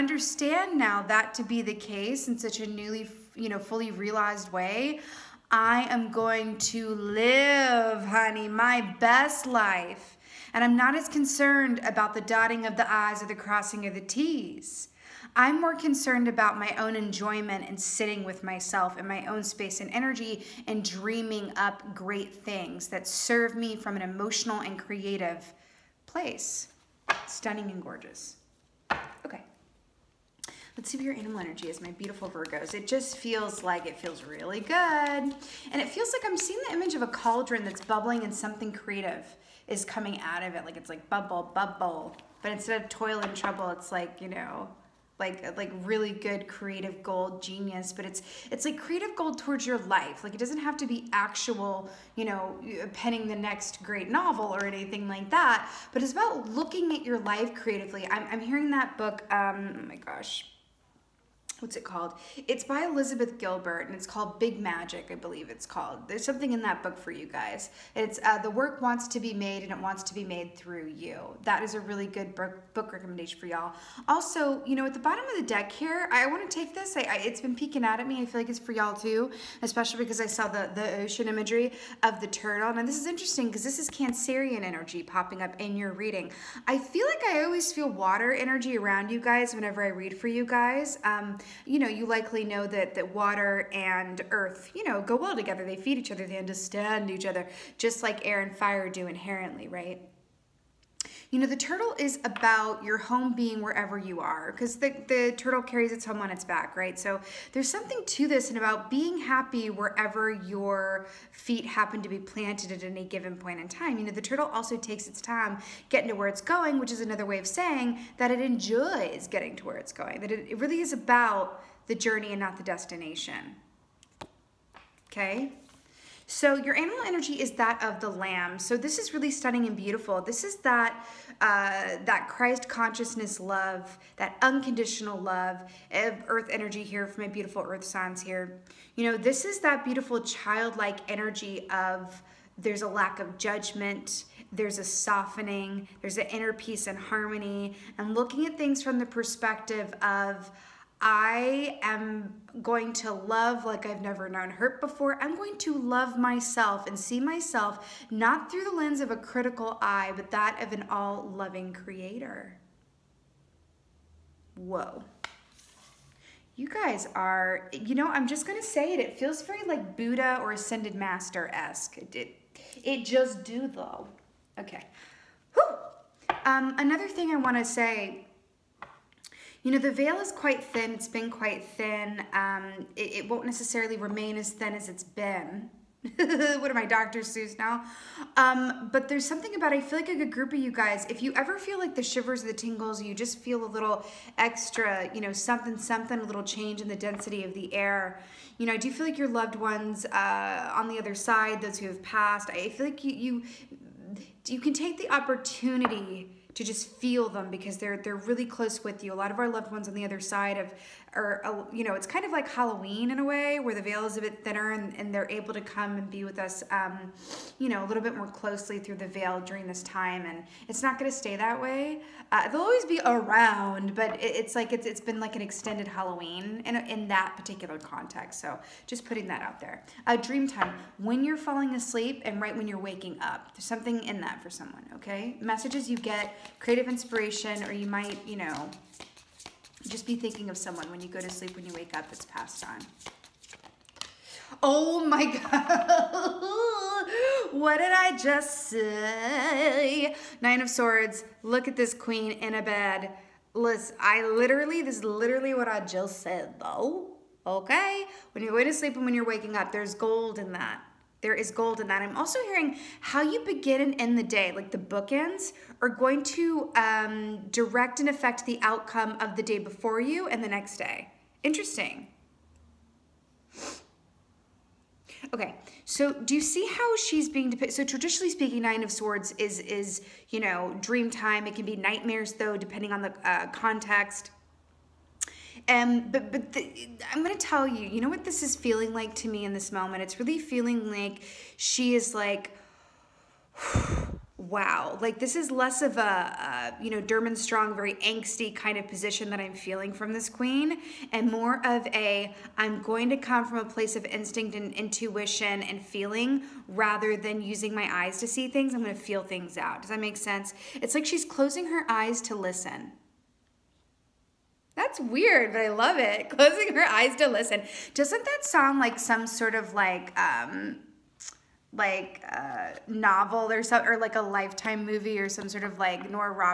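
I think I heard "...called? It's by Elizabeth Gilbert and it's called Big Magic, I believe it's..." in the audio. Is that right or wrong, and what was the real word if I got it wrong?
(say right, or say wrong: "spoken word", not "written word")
right.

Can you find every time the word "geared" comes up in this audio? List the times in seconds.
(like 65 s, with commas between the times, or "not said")
not said.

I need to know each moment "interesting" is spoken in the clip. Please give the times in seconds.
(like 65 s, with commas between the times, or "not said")
83 s, 271 s.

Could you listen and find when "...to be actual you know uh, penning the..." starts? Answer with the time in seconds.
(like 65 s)
50 s.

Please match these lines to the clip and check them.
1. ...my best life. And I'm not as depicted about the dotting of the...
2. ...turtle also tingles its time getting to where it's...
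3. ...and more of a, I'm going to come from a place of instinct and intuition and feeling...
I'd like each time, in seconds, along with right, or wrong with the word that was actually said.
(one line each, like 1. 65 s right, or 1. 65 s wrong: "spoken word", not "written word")
1. 8 s wrong: "concerned", not "depicted"
2. 114 s wrong: "takes", not "tingles"
3. 301 s right.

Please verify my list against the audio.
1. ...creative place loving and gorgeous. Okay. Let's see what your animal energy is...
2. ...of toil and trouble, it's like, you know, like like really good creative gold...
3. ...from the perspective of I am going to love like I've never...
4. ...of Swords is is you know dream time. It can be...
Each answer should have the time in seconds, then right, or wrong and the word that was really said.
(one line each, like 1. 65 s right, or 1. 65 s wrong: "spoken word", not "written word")
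1. 24 s wrong: "stunning", not "loving"
2. 42 s right
3. 148 s right
4. 278 s right.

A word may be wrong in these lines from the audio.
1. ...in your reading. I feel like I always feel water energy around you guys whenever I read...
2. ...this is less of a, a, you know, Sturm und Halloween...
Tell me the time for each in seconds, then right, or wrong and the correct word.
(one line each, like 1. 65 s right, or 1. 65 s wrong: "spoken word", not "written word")
1. 85 s right
2. 295 s wrong: "Drang", not "Halloween".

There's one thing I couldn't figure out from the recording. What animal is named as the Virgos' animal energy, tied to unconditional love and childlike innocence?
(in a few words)
lamb.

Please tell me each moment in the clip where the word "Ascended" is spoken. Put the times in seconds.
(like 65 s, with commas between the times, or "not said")
170 s.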